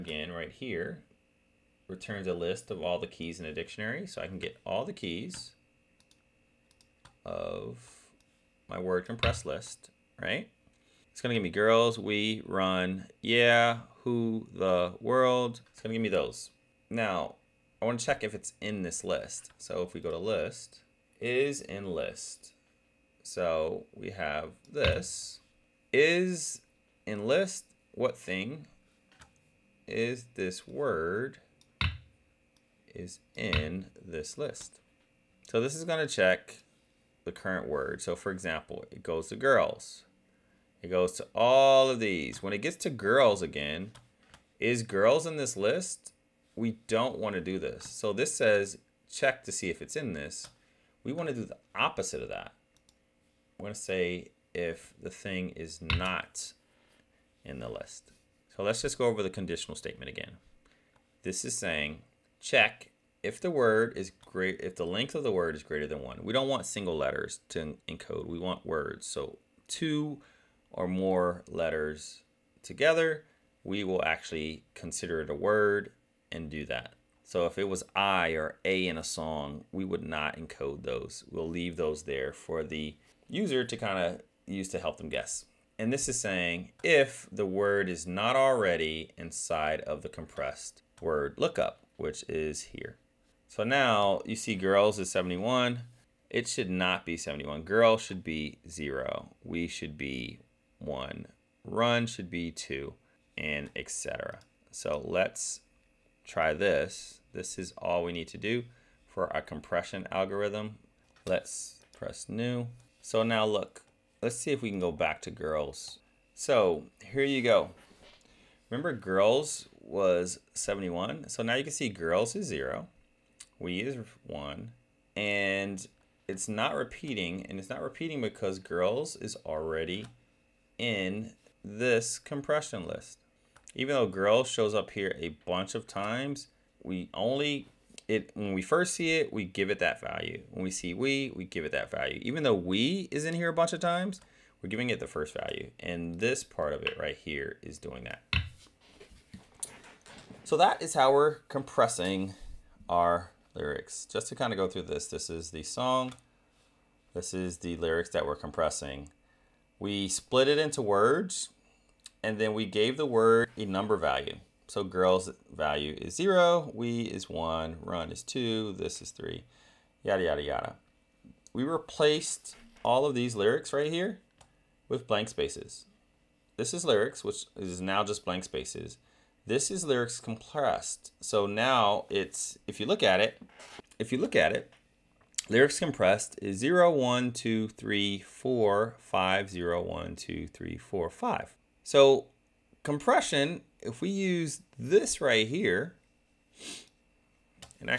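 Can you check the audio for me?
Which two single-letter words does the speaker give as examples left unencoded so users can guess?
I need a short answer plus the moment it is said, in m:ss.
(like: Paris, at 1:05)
I or A, at 1:17.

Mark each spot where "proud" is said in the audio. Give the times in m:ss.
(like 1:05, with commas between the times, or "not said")
not said.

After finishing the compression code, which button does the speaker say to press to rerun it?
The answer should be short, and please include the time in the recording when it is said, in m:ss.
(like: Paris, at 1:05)
new, at 1:52.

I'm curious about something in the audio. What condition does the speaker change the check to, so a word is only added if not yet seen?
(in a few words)
not in the list.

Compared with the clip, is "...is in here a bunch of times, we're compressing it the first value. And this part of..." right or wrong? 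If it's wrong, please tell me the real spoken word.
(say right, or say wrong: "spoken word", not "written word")
wrong: "giving", not "compressing".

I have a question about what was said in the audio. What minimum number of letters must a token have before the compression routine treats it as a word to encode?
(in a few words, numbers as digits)
2 or more letters.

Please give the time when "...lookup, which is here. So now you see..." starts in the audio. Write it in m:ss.
1:31.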